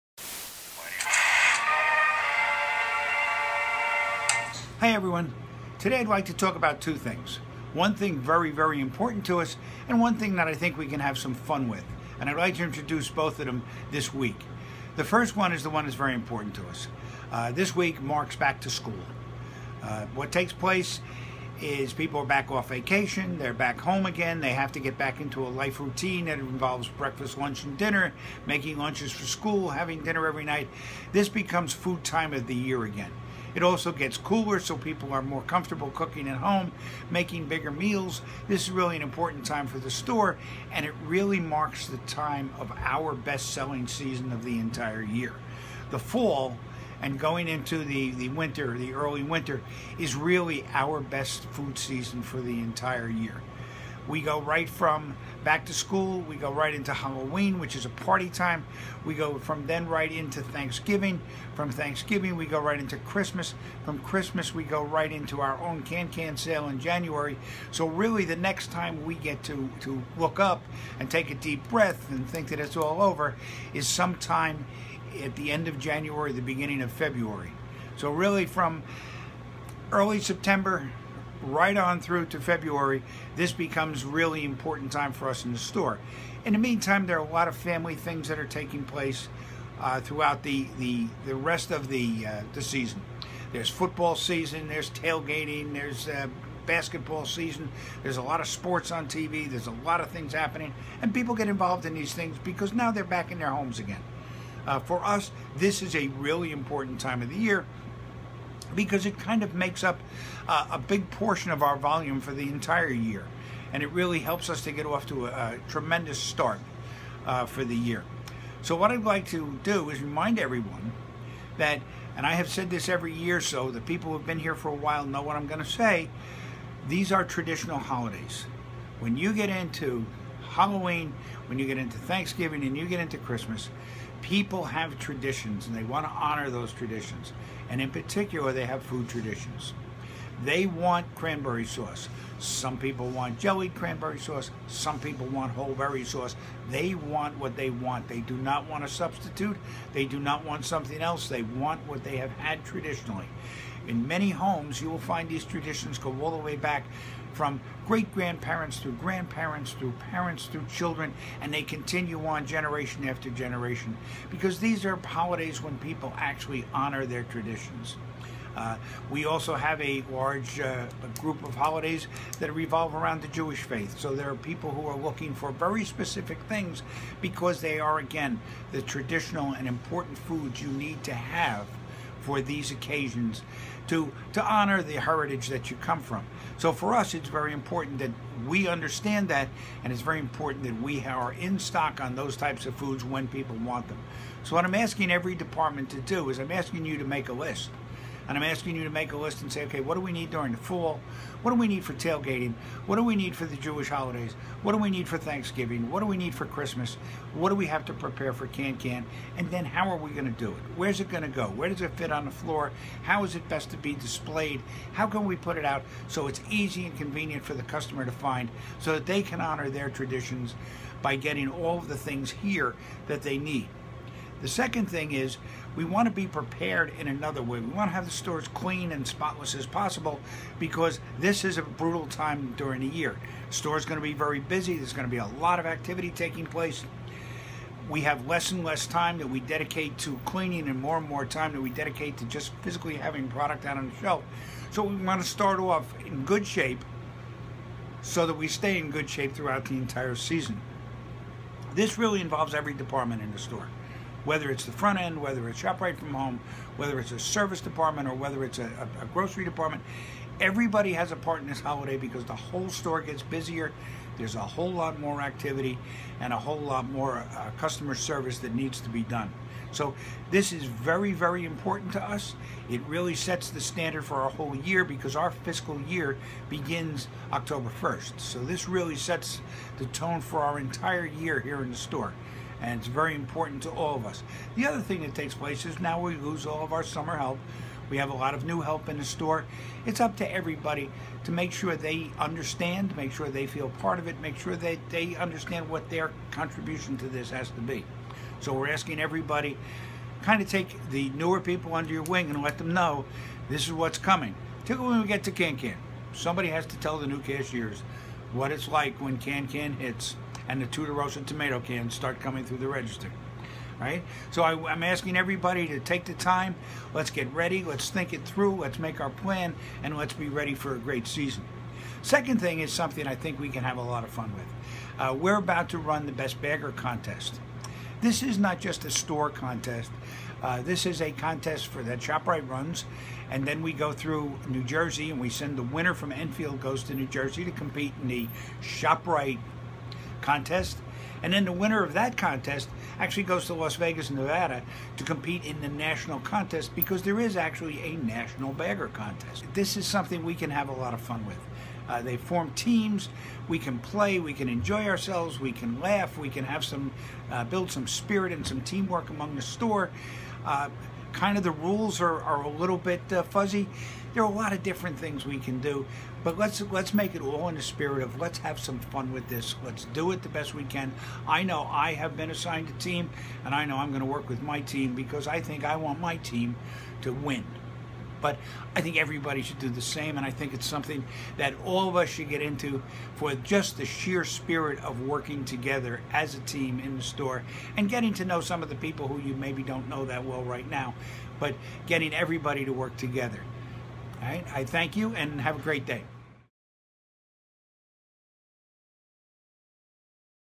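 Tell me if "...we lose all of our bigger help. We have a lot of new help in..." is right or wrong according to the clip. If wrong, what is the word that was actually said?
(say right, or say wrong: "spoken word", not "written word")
wrong: "summer", not "bigger".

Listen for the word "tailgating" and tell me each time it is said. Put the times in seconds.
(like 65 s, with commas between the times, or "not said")
94 s, 201 s.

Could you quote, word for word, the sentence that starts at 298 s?
So we're asking everybody kind of take the newer people under your wing and let them know this is what's coming.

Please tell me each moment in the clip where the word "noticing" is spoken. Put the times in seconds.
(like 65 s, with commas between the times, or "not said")
not said.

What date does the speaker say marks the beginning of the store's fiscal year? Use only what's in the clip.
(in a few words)
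October 1st.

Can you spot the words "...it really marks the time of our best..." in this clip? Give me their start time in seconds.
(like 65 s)
40 s.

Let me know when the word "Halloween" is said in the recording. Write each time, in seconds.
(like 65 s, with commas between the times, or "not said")
56 s, 130 s.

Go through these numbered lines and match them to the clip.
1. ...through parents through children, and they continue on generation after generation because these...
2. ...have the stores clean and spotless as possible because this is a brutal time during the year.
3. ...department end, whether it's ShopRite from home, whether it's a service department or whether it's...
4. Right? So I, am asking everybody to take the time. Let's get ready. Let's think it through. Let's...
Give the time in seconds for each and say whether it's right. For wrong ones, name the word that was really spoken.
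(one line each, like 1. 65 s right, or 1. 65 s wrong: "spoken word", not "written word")
1. 159 s right
2. 227 s right
3. 254 s wrong: "front", not "department"
4. 313 s right.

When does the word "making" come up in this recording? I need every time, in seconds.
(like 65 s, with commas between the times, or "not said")
28 s, 37 s.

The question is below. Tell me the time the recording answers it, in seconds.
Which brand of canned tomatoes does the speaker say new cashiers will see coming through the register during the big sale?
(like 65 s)
310 s.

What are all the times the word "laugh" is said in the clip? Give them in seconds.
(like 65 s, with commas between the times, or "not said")
355 s.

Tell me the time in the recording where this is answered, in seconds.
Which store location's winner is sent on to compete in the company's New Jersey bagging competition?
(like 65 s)
336 s.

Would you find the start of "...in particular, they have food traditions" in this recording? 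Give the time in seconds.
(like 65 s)
137 s.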